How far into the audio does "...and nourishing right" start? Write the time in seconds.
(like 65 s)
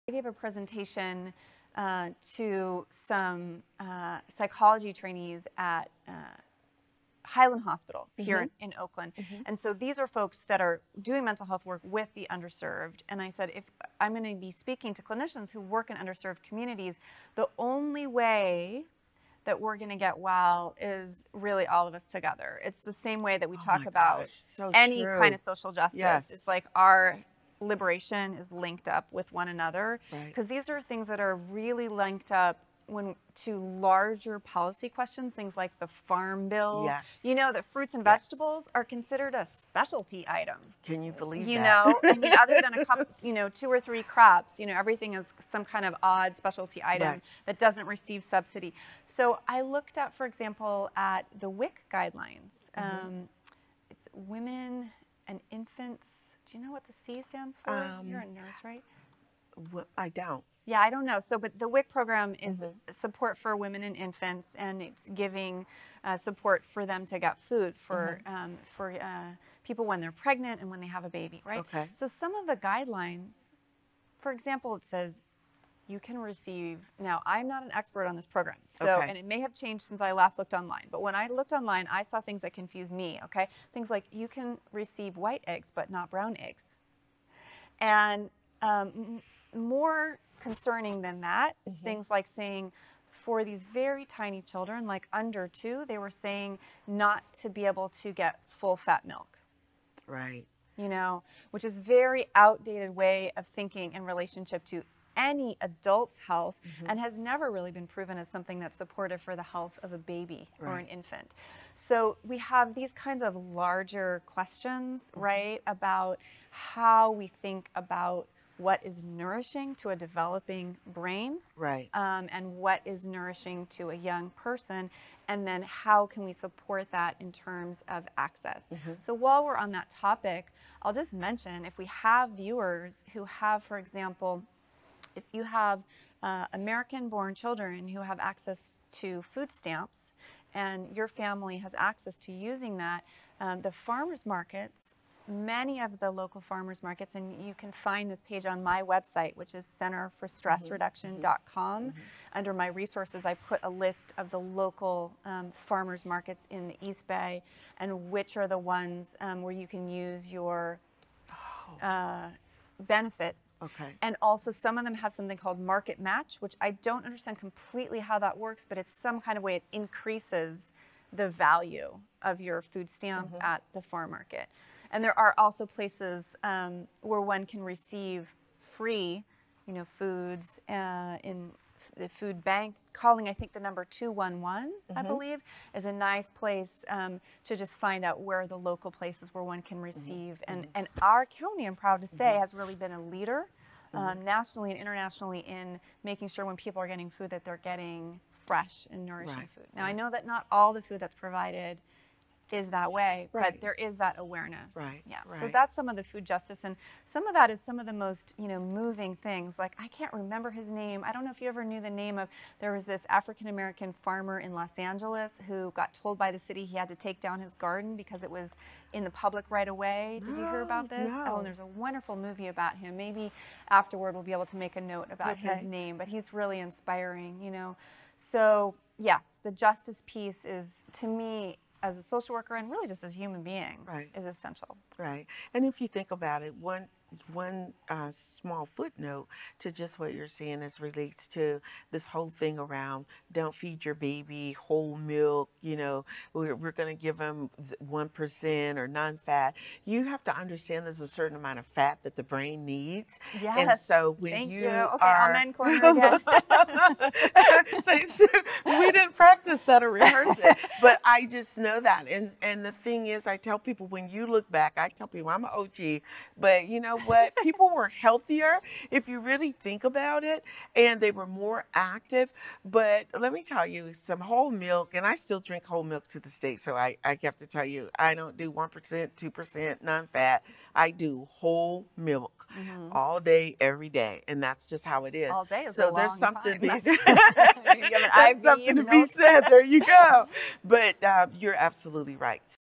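198 s.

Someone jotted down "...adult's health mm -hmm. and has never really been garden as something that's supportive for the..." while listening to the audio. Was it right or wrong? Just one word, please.
wrong.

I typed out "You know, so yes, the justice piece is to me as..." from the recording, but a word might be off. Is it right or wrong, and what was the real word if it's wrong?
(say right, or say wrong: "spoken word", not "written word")
right.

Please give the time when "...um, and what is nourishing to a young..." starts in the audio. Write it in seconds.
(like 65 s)
122 s.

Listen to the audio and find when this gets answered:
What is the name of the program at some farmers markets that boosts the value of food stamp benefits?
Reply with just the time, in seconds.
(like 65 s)
165 s.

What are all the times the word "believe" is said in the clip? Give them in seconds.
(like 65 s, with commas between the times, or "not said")
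41 s, 185 s.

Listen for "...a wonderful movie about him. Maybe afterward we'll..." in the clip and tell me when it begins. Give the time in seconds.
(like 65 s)
221 s.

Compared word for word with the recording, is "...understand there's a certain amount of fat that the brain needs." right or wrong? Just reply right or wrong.
right.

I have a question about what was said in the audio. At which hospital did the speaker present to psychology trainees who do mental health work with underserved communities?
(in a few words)
Highland Hospital.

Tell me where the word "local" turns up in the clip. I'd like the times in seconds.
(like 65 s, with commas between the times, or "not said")
146 s, 154 s, 188 s.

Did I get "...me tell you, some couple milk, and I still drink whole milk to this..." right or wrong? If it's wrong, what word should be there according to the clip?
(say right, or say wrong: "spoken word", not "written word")
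wrong: "whole", not "couple".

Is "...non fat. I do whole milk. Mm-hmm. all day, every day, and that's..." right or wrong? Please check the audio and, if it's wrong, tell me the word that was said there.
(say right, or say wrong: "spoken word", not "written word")
right.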